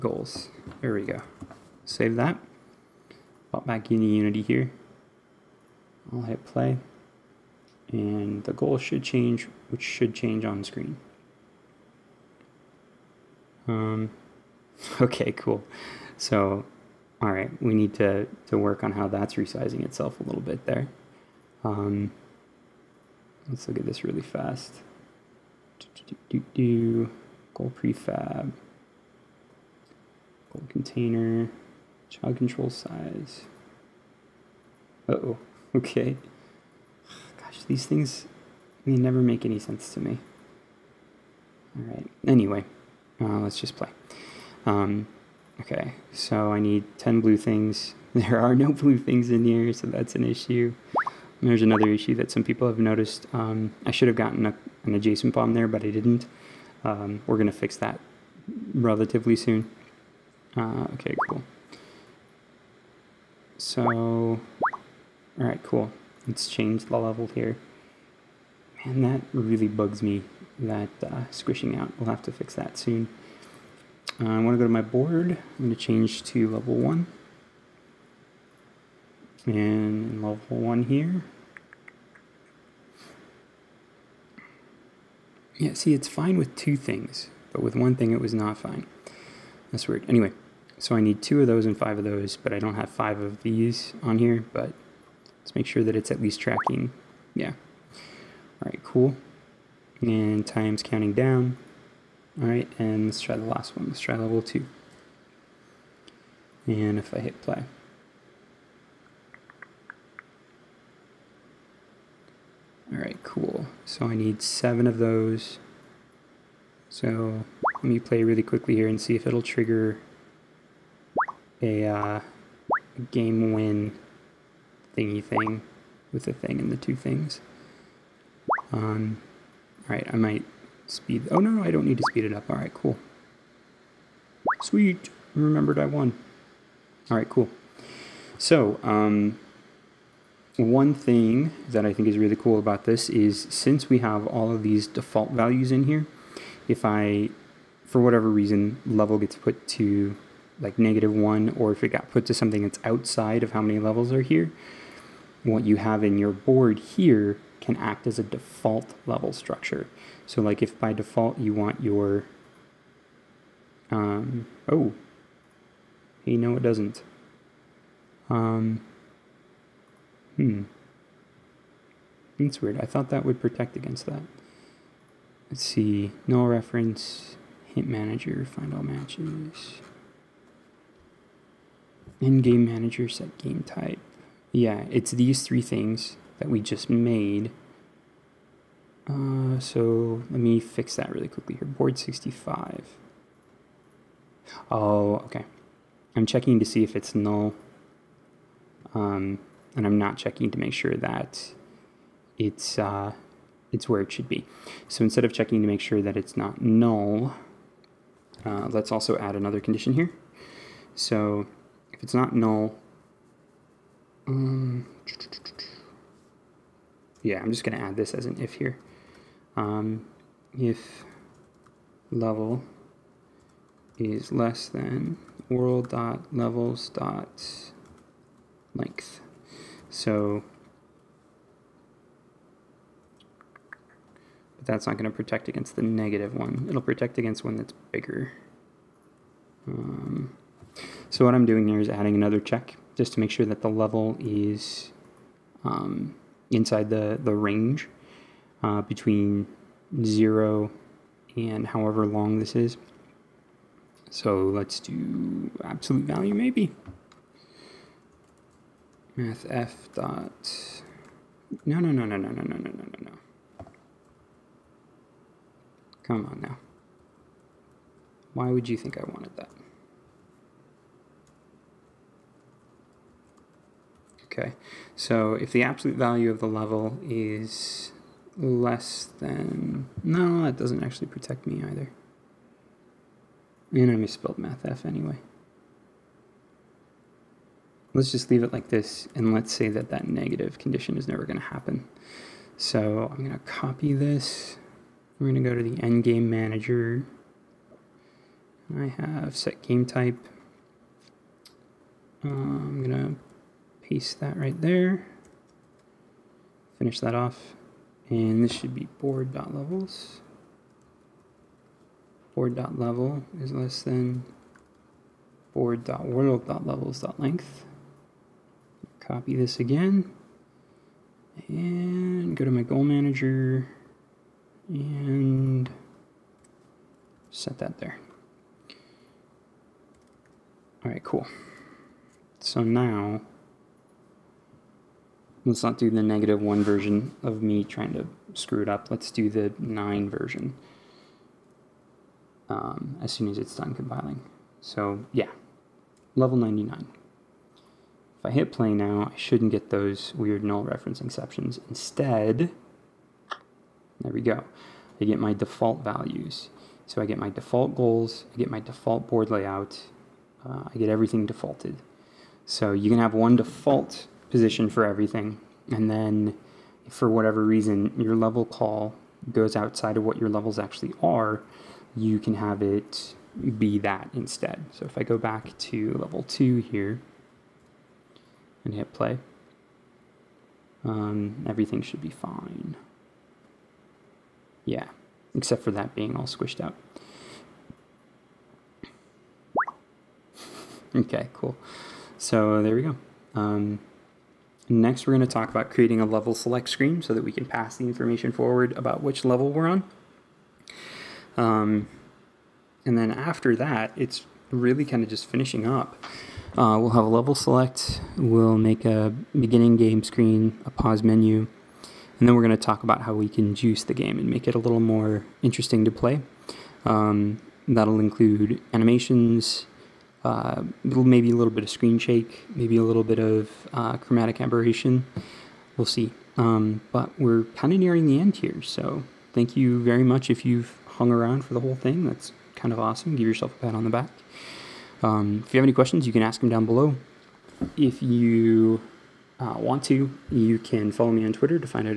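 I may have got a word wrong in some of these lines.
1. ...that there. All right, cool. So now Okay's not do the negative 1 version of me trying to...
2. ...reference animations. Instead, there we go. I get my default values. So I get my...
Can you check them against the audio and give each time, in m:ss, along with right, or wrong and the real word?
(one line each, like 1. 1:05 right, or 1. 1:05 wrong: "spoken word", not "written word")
1. 5:27 wrong: "Let", not "Okay"
2. 5:50 wrong: "exceptions", not "animations".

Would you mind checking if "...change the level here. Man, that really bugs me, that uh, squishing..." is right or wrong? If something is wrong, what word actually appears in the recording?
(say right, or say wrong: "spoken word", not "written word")
right.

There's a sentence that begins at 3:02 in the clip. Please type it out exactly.
In game manager, set game type.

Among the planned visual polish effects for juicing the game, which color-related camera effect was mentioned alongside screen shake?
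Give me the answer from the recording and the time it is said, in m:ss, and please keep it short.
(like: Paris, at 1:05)
chromatic aberration, at 7:03.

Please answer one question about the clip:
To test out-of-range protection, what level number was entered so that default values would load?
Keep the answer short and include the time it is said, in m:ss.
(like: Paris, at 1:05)
99, at 5:46.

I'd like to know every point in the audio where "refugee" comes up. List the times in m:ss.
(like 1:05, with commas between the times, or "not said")
not said.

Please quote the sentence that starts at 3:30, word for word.
So if it's not null, um, yeah, I'm just going to add this as an if here.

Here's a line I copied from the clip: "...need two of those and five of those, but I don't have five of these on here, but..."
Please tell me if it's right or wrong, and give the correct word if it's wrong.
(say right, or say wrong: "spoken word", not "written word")
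right.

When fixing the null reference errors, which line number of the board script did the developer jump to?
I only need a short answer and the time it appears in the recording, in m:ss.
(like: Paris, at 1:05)
65, at 3:11.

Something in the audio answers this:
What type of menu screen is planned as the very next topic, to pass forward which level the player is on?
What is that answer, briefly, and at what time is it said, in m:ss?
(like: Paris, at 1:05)
level select screen, at 6:36.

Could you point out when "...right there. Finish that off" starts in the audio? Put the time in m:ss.
5:04.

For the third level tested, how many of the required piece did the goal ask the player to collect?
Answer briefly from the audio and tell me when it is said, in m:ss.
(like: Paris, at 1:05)
7, at 1:54.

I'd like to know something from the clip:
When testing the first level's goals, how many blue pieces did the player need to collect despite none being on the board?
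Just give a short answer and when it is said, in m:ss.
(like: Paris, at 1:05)
10, at 0:46.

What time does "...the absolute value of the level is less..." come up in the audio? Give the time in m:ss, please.
4:35.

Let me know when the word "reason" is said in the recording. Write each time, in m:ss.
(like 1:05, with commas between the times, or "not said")
2:28, 6:07.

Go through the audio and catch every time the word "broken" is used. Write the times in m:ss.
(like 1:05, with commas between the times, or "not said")
not said.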